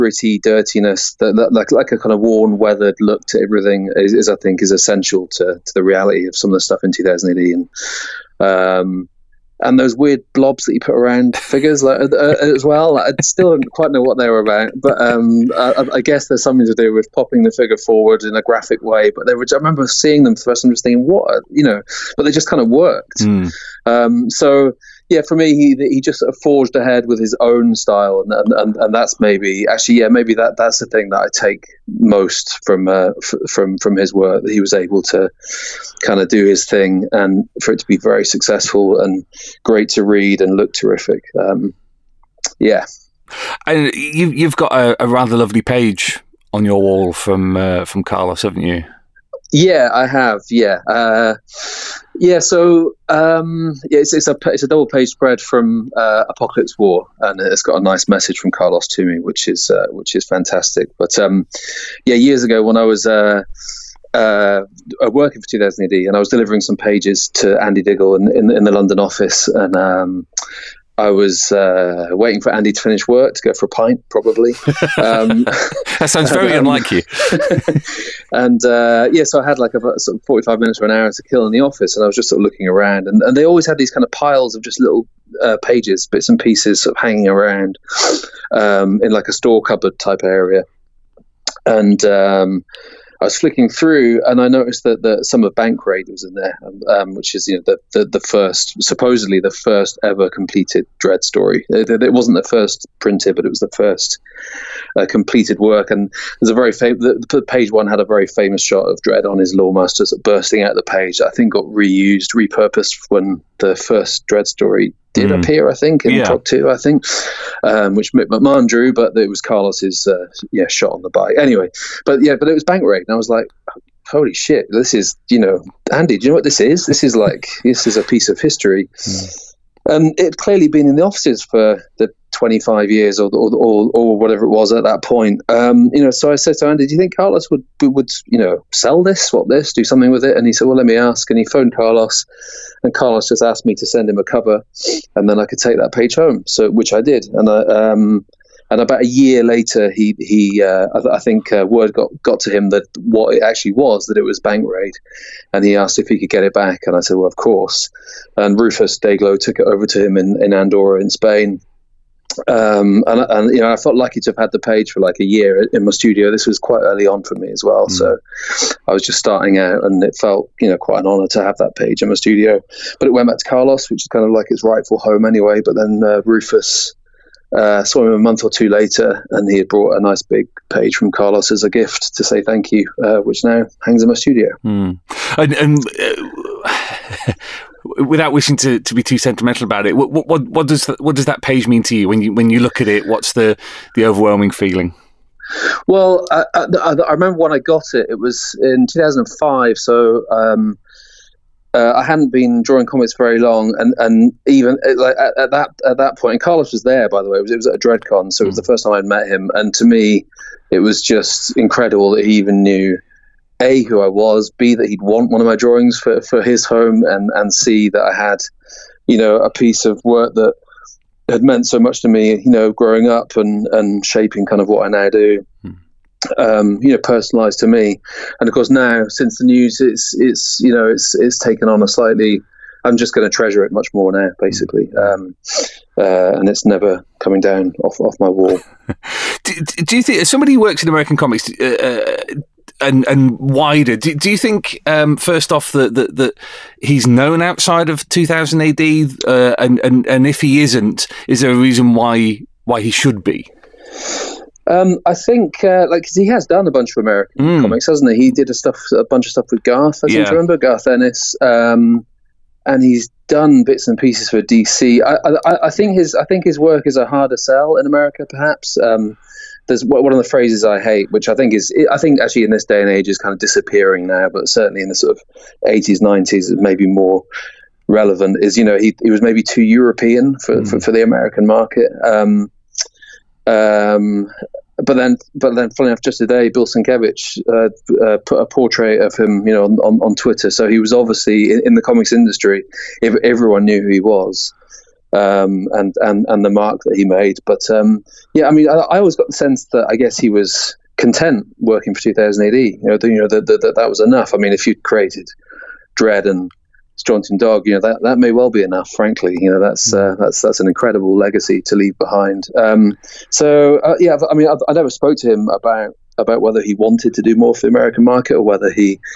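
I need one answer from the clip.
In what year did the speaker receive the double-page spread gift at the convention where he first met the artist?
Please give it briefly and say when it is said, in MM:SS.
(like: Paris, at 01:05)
2005, at 03:18.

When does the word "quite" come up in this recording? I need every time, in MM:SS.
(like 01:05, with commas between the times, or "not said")
00:13, 02:46, 02:50.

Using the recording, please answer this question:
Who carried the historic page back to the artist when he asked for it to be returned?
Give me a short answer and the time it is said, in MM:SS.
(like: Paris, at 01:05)
Rufus Dayglo, at 02:38.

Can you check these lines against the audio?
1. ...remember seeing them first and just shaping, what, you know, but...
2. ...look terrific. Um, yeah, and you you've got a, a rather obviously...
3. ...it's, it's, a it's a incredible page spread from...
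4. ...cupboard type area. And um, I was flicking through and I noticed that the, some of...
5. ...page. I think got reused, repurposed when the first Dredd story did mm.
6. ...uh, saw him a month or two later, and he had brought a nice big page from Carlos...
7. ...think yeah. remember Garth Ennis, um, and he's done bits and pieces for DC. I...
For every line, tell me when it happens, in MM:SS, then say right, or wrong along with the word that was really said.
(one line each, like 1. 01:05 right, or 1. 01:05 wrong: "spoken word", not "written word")
1. 00:19 wrong: "thinking", not "shaping"
2. 00:40 wrong: "lovely", not "obviously"
3. 00:53 wrong: "double", not "incredible"
4. 01:29 right
5. 01:50 right
6. 02:57 right
7. 04:20 right.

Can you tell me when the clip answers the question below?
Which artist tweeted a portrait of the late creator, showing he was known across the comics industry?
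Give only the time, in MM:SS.
04:46.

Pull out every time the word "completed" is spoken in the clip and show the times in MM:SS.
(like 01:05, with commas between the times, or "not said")
01:40, 01:45.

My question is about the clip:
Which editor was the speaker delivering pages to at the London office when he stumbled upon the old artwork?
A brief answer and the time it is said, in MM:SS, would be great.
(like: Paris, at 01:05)
Andy Diggle, at 01:07.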